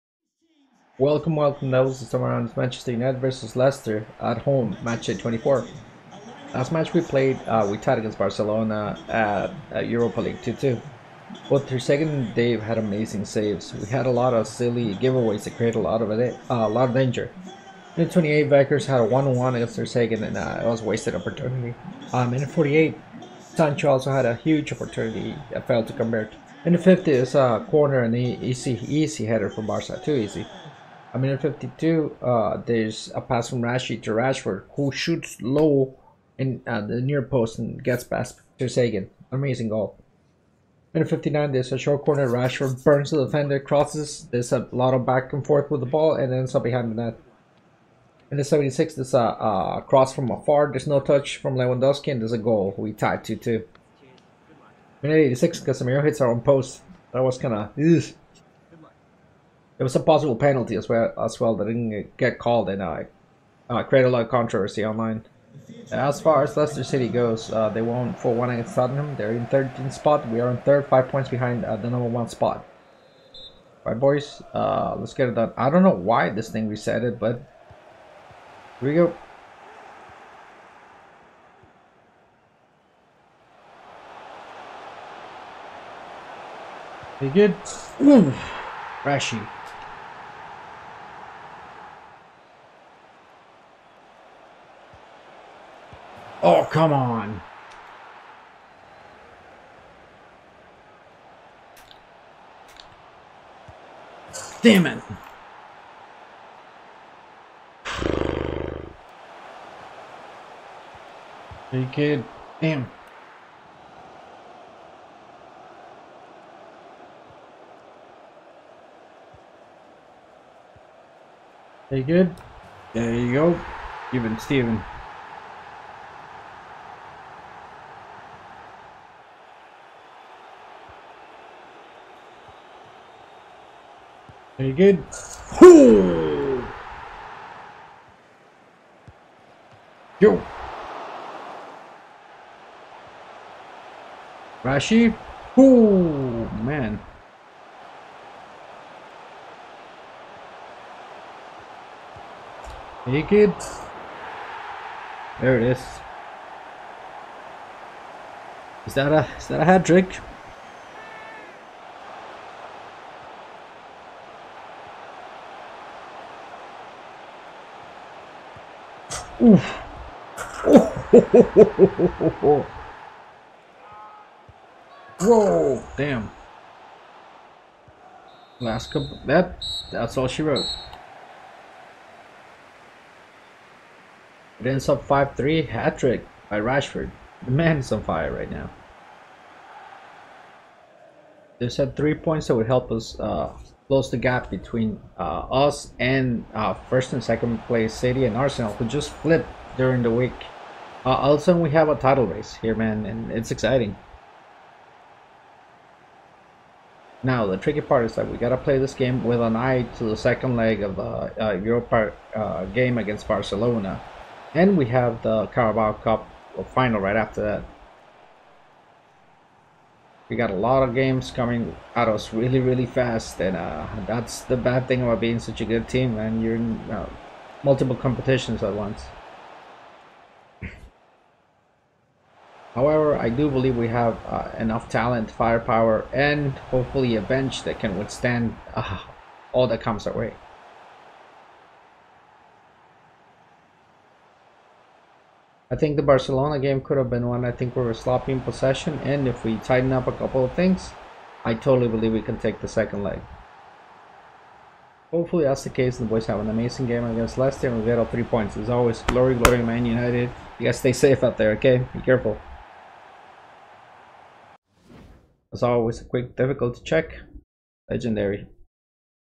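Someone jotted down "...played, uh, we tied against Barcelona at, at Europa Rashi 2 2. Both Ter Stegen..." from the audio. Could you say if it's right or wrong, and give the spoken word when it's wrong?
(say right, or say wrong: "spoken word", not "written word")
wrong: "League", not "Rashi".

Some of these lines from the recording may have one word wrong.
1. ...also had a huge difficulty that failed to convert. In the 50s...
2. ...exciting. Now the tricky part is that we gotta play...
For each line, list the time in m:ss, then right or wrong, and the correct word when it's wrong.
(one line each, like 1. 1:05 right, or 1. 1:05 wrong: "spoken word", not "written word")
1. 0:23 wrong: "opportunity", not "difficulty"
2. 3:23 right.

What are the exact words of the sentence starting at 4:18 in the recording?
As always, glory, glory, Man United.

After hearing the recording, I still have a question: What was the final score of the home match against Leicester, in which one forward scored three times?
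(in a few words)
5-3.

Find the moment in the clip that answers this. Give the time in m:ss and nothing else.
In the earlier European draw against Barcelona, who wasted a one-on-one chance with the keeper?
0:18.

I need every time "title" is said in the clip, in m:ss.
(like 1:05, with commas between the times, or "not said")
3:21.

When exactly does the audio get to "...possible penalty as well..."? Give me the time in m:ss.
0:59.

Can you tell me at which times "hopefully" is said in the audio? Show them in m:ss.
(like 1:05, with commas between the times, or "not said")
3:56, 4:15.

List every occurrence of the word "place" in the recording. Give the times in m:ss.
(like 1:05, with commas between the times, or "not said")
3:17.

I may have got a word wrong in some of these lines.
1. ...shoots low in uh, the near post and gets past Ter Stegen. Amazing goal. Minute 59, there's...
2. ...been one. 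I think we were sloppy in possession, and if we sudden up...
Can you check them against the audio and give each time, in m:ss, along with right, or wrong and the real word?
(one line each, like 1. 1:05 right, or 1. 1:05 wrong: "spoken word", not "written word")
1. 0:34 right
2. 4:07 wrong: "tighten", not "sudden".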